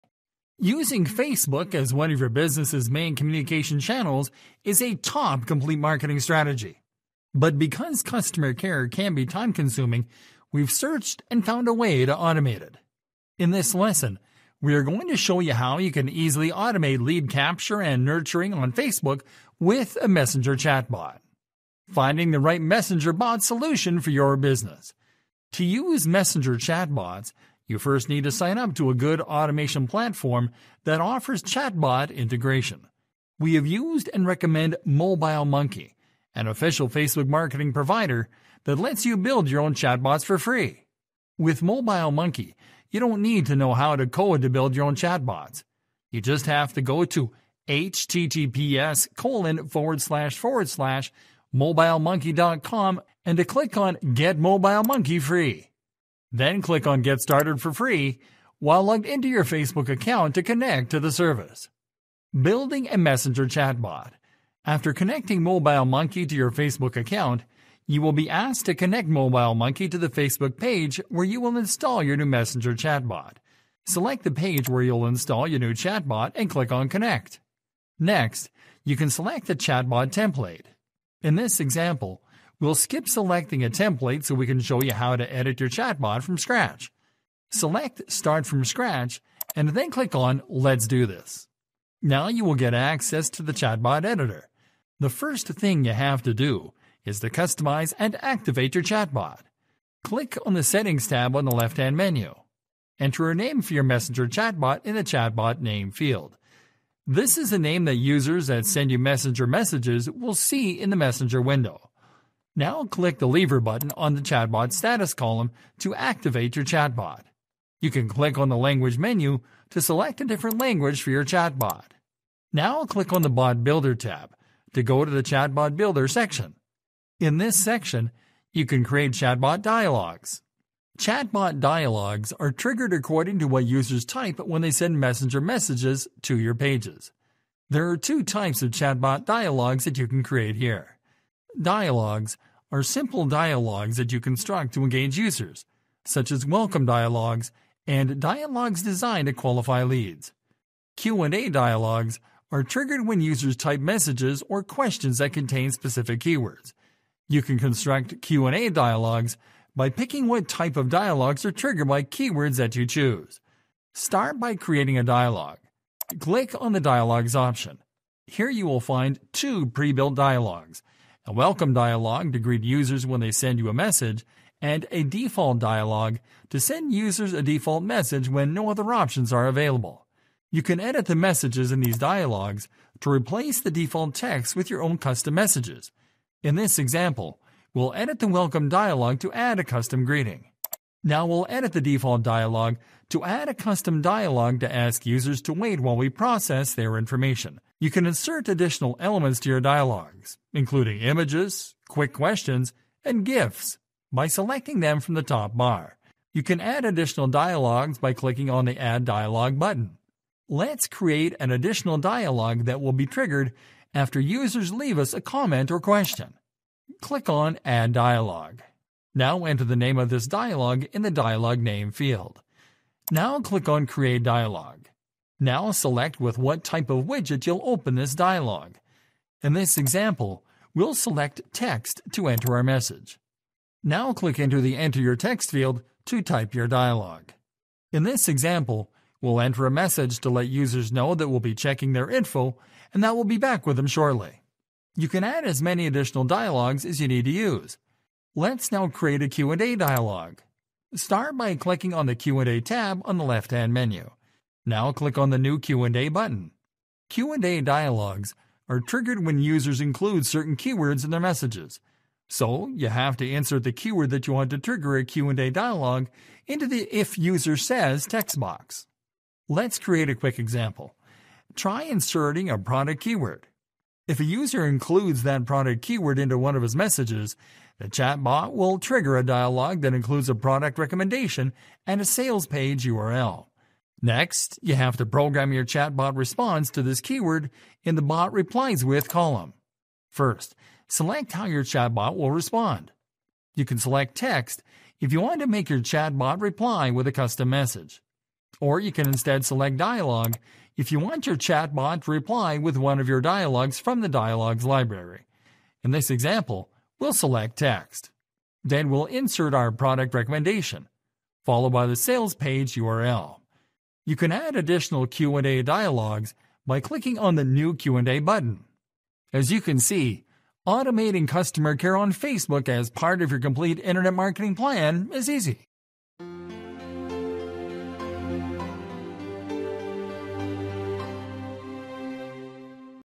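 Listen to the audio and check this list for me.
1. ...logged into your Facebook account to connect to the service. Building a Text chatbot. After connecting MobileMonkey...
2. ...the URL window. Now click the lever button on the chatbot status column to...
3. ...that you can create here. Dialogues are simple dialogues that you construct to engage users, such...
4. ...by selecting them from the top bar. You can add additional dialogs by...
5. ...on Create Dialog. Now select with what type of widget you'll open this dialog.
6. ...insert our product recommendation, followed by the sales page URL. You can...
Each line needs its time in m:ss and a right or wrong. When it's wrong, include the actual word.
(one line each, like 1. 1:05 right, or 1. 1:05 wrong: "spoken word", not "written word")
1. 0:58 wrong: "Messenger", not "Text"
2. 1:50 wrong: "Messenger", not "URL"
3. 2:19 right
4. 3:24 right
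5. 3:43 right
6. 5:09 right.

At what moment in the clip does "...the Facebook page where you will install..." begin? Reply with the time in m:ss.
1:09.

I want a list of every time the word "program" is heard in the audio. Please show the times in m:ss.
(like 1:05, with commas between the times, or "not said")
4:45.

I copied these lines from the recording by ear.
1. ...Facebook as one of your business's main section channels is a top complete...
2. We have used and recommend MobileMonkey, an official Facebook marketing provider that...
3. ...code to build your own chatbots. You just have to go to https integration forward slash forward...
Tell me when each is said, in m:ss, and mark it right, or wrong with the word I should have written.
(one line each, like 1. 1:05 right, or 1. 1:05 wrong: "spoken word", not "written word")
1. 0:01 wrong: "communication", not "section"
2. 0:33 right
3. 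0:44 wrong: "colon", not "integration".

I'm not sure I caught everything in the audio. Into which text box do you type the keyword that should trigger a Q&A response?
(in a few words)
if user says.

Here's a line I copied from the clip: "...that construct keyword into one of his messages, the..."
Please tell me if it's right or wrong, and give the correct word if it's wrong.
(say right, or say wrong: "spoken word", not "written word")
wrong: "product", not "construct".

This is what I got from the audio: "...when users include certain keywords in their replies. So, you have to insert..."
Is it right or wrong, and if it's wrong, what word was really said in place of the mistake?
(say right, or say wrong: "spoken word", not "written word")
wrong: "messages", not "replies".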